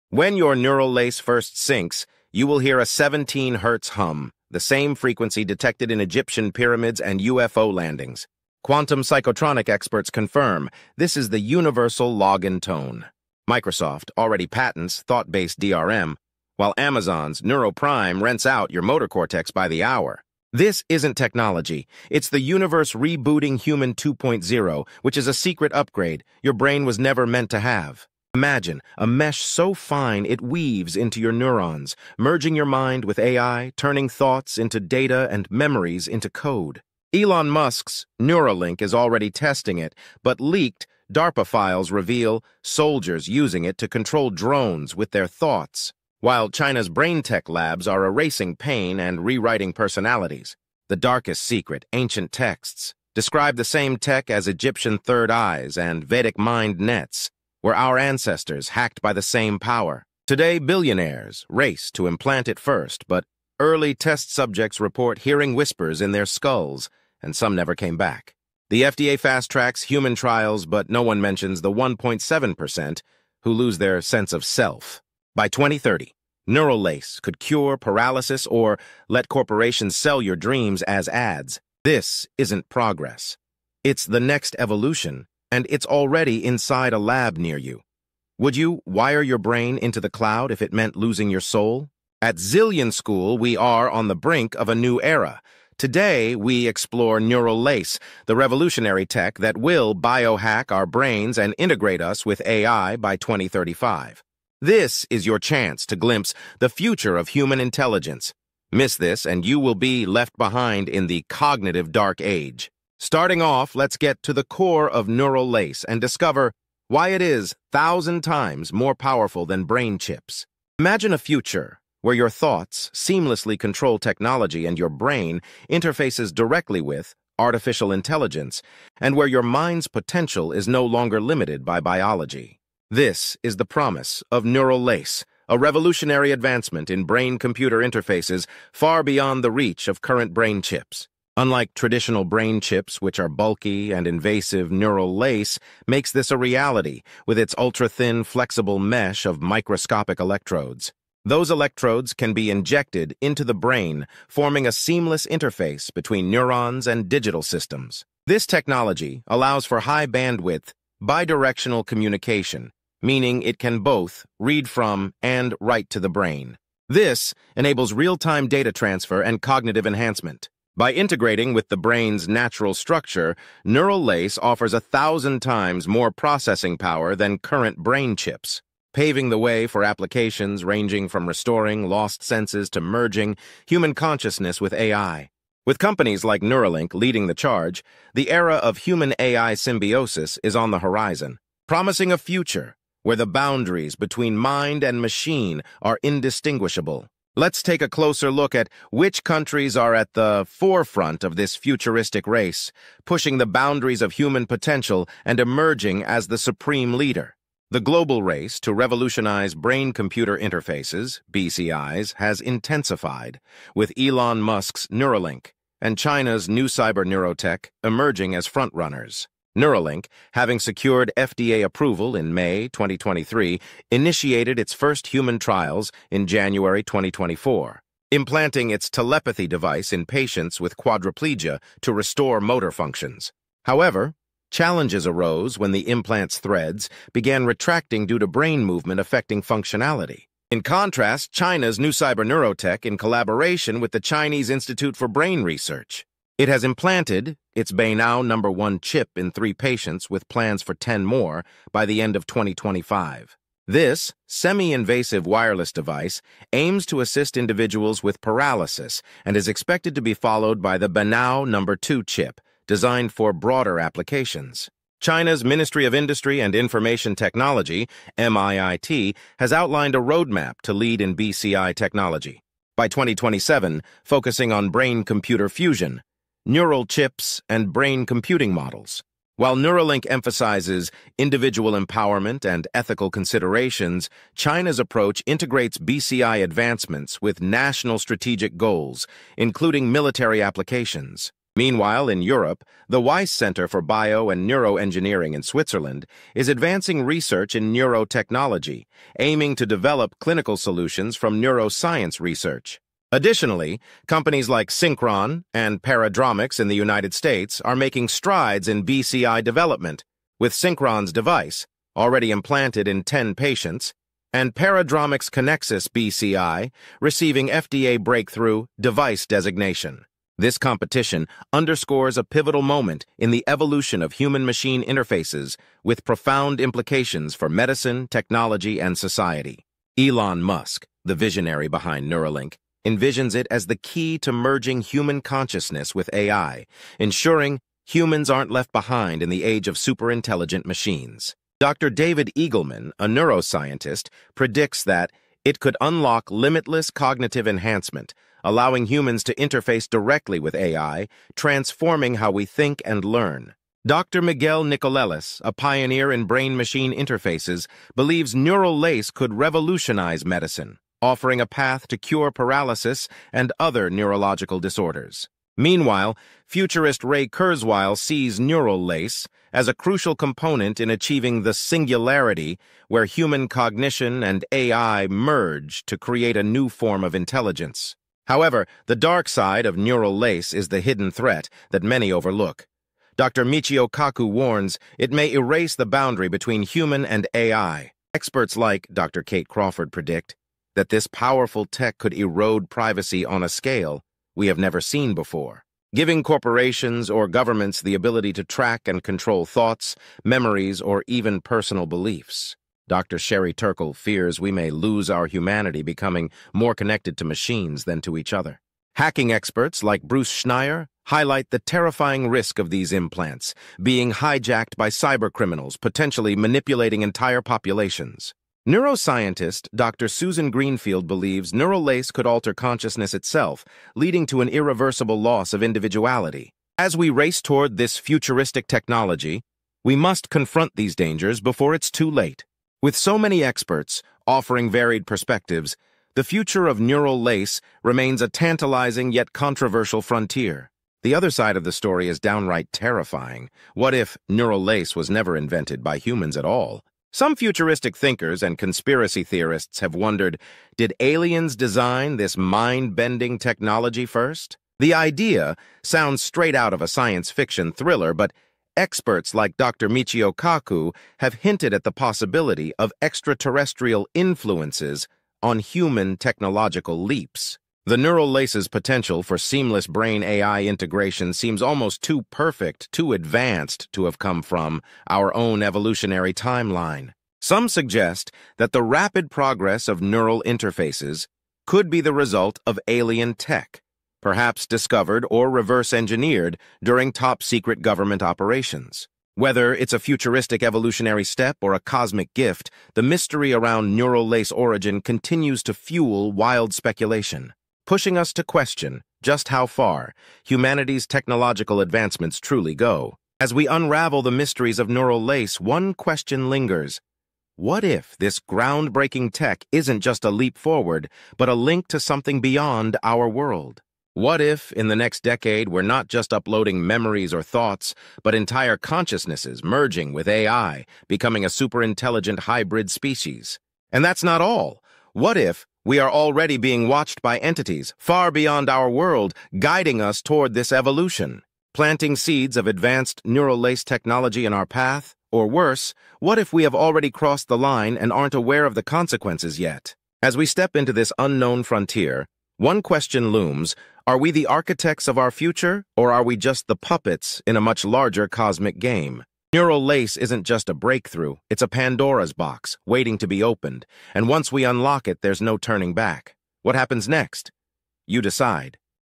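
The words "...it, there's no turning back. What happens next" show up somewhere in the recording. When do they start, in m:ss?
9:15.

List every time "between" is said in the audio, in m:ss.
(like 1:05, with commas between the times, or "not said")
2:35, 3:13, 6:26.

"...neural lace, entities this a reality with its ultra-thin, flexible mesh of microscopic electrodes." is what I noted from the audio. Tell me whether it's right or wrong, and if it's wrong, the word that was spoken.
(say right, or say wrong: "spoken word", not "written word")
wrong: "makes", not "entities".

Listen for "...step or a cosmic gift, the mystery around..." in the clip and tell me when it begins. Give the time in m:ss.
8:11.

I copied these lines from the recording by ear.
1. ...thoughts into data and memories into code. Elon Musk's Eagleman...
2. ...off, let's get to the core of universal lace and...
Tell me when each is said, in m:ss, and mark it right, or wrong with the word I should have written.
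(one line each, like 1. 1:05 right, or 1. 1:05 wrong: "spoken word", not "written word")
1. 0:34 wrong: "Neuralink", not "Eagleman"
2. 1:53 wrong: "neural", not "universal".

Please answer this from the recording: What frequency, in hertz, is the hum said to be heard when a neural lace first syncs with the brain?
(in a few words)
17 hertz.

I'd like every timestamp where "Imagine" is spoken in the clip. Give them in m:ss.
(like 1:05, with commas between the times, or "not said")
0:28, 2:00.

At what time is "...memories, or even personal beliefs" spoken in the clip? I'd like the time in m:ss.
6:40.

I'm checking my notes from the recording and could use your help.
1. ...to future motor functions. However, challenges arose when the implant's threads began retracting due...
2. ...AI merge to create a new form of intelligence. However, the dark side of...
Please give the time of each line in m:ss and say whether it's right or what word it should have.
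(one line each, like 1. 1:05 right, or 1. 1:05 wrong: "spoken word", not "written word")
1. 3:51 wrong: "restore", not "future"
2. 6:14 right.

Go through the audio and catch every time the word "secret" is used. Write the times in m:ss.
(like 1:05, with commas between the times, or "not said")
0:25, 0:51, 8:07.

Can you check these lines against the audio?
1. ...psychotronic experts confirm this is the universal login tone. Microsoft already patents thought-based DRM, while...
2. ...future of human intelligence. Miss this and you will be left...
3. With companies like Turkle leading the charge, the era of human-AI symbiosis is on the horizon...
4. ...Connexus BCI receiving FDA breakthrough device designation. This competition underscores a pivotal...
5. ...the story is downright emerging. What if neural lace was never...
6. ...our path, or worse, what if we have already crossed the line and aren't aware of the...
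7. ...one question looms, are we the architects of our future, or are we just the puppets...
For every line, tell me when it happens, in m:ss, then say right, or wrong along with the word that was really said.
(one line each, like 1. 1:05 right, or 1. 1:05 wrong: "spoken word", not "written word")
1. 0:09 right
2. 1:46 right
3. 3:05 wrong: "Neuralink", not "Turkle"
4. 5:15 right
5. 7:21 wrong: "terrifying", not "emerging"
6. 8:54 right
7. 9:02 right.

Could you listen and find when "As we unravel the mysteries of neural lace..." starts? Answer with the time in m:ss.
8:23.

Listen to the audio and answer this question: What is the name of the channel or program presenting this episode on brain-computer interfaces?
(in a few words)
Zillion School.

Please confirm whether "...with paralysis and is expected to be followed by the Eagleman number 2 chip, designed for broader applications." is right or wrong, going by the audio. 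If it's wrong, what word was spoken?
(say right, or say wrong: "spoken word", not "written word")
wrong: "Beinao", not "Eagleman".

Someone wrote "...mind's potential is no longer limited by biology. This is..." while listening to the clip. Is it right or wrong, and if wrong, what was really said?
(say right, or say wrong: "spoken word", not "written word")
right.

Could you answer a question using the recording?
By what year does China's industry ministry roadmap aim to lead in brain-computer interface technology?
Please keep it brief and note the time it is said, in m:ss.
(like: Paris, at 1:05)
2027, at 4:32.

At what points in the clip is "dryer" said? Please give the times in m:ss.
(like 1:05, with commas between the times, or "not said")
not said.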